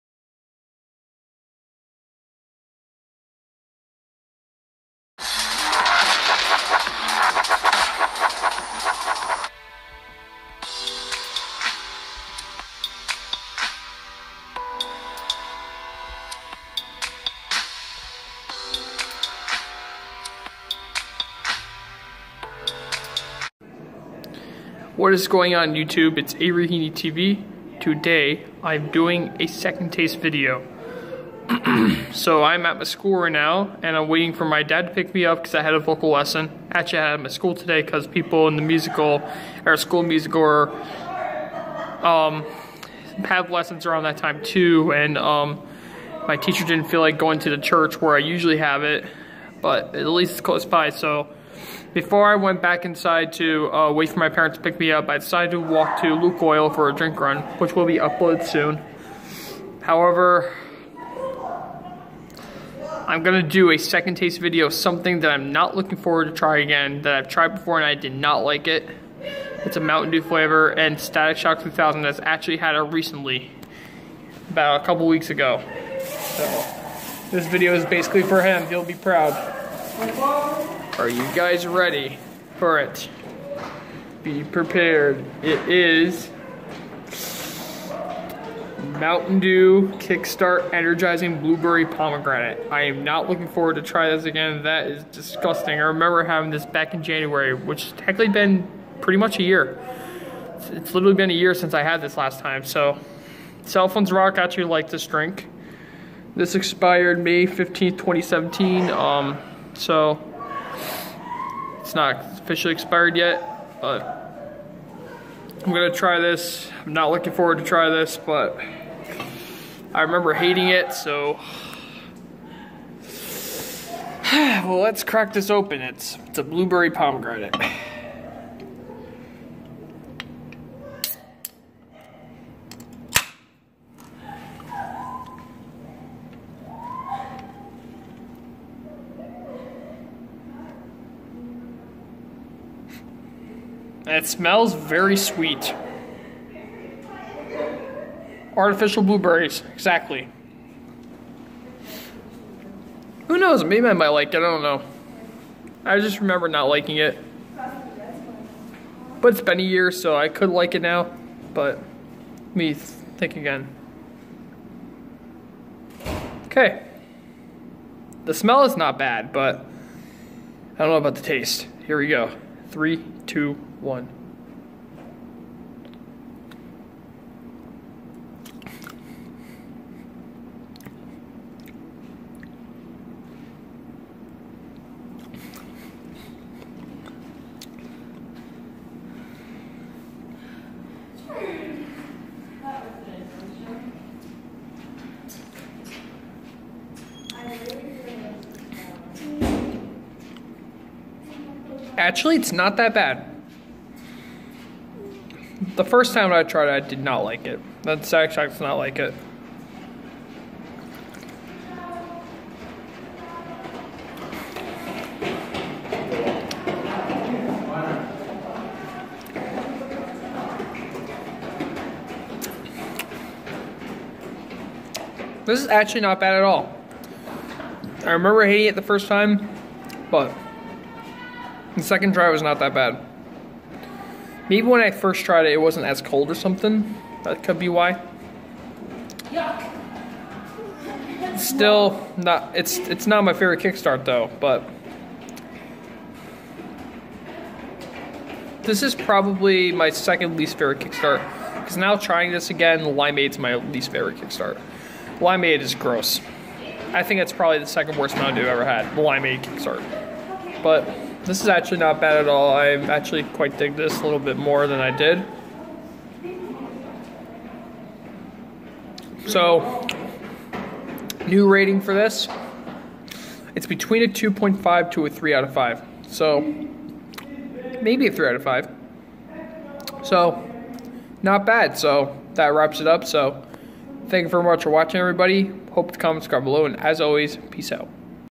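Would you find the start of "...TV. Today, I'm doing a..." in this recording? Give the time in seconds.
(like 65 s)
26 s.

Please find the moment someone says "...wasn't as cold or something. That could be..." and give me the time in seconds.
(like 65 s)
235 s.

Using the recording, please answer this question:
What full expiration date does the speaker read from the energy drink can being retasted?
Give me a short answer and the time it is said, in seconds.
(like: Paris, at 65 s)
May 15th, 2017, at 107 s.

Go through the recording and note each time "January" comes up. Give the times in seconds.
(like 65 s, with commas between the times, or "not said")
97 s.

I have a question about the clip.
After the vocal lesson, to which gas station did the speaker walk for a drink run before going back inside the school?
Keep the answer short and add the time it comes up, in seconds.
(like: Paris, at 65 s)
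Lukoil, at 56 s.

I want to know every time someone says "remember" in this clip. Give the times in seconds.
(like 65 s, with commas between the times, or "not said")
95 s, 119 s, 156 s, 228 s.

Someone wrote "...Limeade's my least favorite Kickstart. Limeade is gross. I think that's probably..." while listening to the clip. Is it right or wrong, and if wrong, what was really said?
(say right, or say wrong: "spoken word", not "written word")
right.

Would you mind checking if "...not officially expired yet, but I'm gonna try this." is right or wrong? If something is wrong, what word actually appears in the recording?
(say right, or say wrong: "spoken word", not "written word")
right.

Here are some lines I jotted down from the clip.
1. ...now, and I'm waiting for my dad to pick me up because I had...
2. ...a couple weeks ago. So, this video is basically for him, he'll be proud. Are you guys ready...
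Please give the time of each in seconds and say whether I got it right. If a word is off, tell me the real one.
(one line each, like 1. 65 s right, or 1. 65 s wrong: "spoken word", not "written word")
1. 33 s right
2. 74 s right.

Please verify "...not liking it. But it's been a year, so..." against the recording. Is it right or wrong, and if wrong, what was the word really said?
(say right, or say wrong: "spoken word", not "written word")
right.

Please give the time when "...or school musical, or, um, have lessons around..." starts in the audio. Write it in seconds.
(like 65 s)
39 s.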